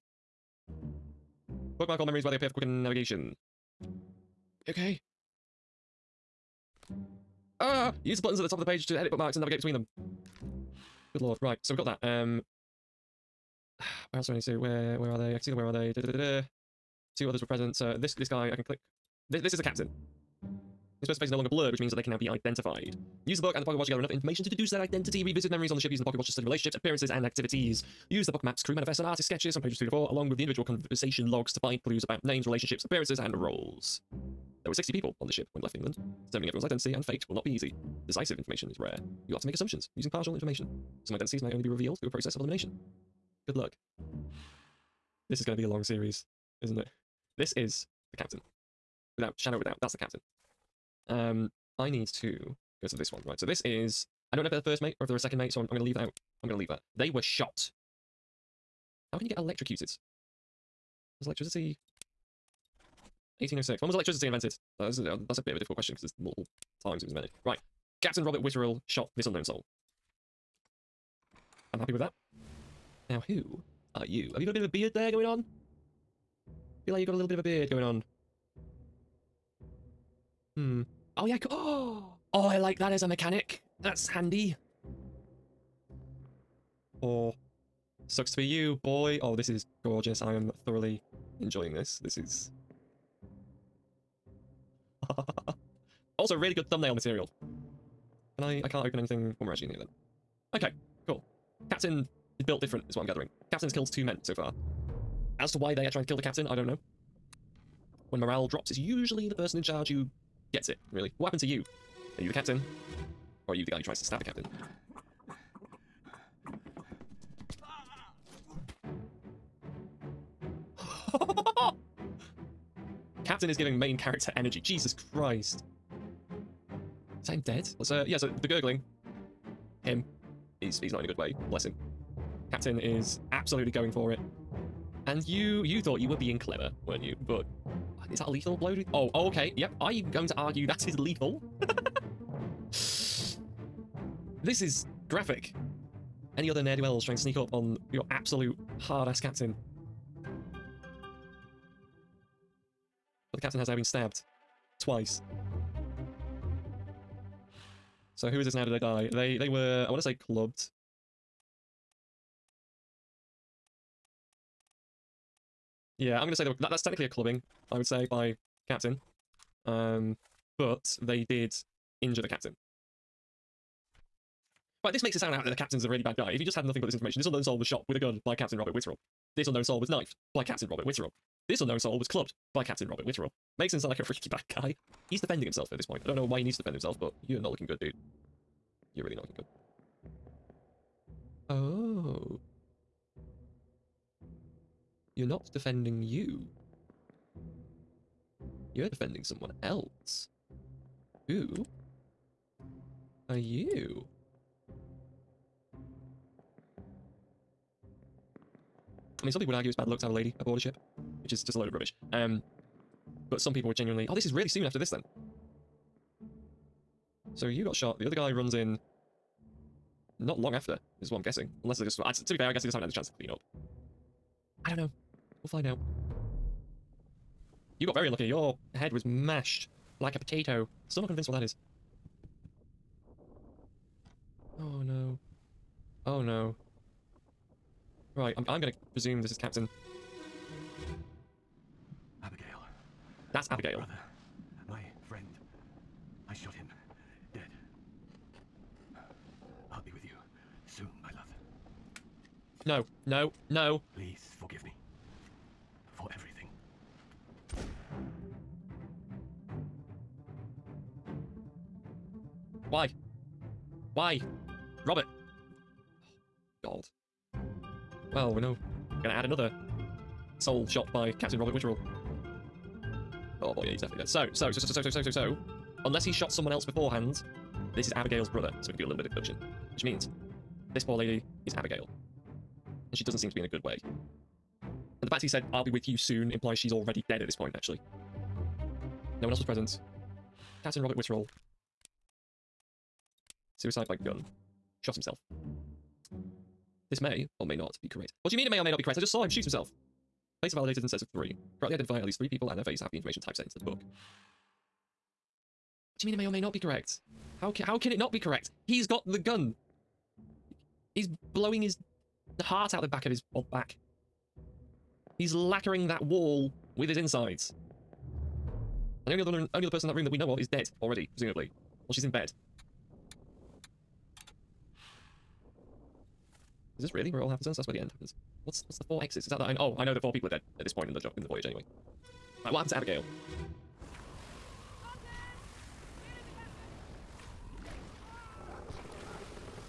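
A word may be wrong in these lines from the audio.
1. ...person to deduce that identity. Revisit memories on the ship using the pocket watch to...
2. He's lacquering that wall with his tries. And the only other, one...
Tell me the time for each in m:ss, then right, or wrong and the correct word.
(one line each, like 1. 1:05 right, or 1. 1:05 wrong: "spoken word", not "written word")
1. 0:24 wrong: "information", not "person"
2. 5:15 wrong: "insides", not "tries".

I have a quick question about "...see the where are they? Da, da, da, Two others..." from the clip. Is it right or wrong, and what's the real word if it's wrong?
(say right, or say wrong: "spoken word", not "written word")
right.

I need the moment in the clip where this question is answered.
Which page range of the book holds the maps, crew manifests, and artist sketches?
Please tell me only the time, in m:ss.
0:29.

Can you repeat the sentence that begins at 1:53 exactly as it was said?
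Or are you the guy who tries to stab the captain?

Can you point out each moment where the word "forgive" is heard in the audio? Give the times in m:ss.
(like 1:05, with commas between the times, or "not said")
4:14.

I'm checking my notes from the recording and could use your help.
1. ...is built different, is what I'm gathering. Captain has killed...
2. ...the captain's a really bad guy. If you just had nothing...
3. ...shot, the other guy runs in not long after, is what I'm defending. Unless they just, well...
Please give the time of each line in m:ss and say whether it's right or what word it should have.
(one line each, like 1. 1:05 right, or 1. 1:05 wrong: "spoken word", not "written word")
1. 1:42 right
2. 2:55 right
3. 3:37 wrong: "guessing", not "defending".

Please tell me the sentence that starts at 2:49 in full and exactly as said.
Um, but they did injure the captain.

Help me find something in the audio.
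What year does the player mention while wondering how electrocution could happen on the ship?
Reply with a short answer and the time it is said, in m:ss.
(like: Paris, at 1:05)
1806, at 1:03.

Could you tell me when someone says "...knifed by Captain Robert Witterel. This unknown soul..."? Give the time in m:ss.
2:59.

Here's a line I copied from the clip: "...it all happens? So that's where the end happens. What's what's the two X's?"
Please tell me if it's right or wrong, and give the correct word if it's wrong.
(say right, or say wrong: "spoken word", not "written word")
wrong: "four", not "two".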